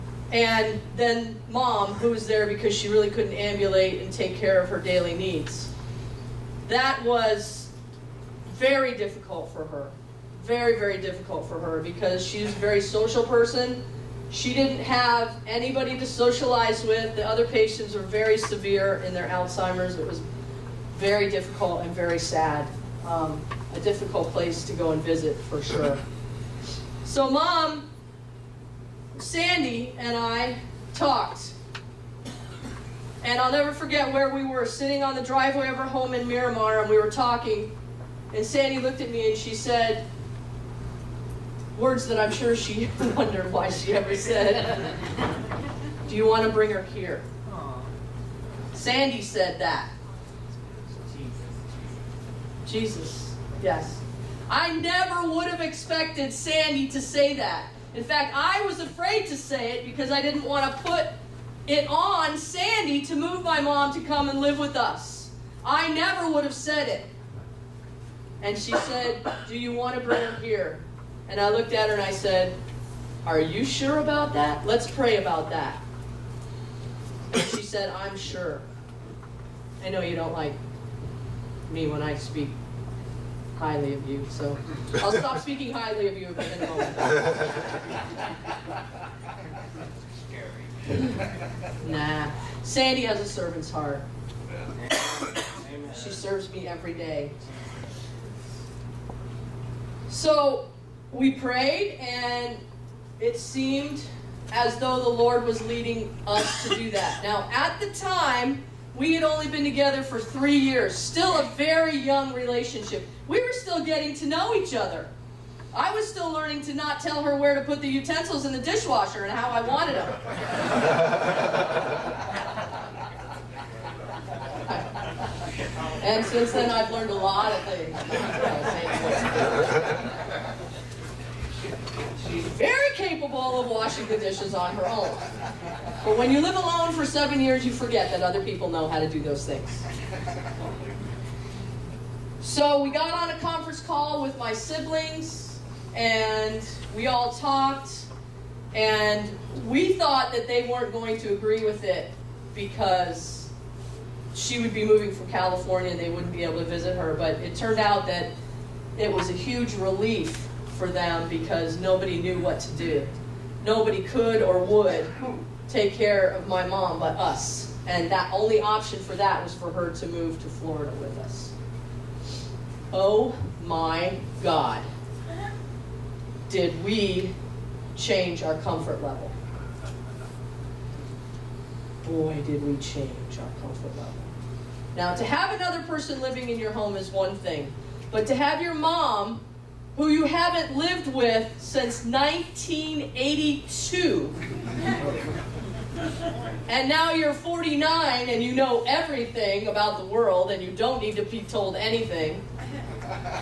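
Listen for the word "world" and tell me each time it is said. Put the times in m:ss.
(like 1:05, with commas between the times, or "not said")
3:20.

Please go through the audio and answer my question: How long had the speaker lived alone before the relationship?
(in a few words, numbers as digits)
7 years.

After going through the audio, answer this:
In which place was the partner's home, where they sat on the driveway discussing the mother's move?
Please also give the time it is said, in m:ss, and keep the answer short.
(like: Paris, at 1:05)
Miramar, at 0:36.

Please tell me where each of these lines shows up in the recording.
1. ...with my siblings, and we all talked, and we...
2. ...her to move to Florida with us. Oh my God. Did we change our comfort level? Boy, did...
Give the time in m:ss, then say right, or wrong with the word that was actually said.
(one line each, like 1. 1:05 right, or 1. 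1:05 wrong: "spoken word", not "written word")
1. 2:24 right
2. 2:49 right.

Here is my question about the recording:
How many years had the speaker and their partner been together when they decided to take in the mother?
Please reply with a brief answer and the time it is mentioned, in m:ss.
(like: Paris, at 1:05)
3, at 1:50.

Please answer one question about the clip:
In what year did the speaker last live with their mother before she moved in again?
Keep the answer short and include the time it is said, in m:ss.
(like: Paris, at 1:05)
1982, at 3:12.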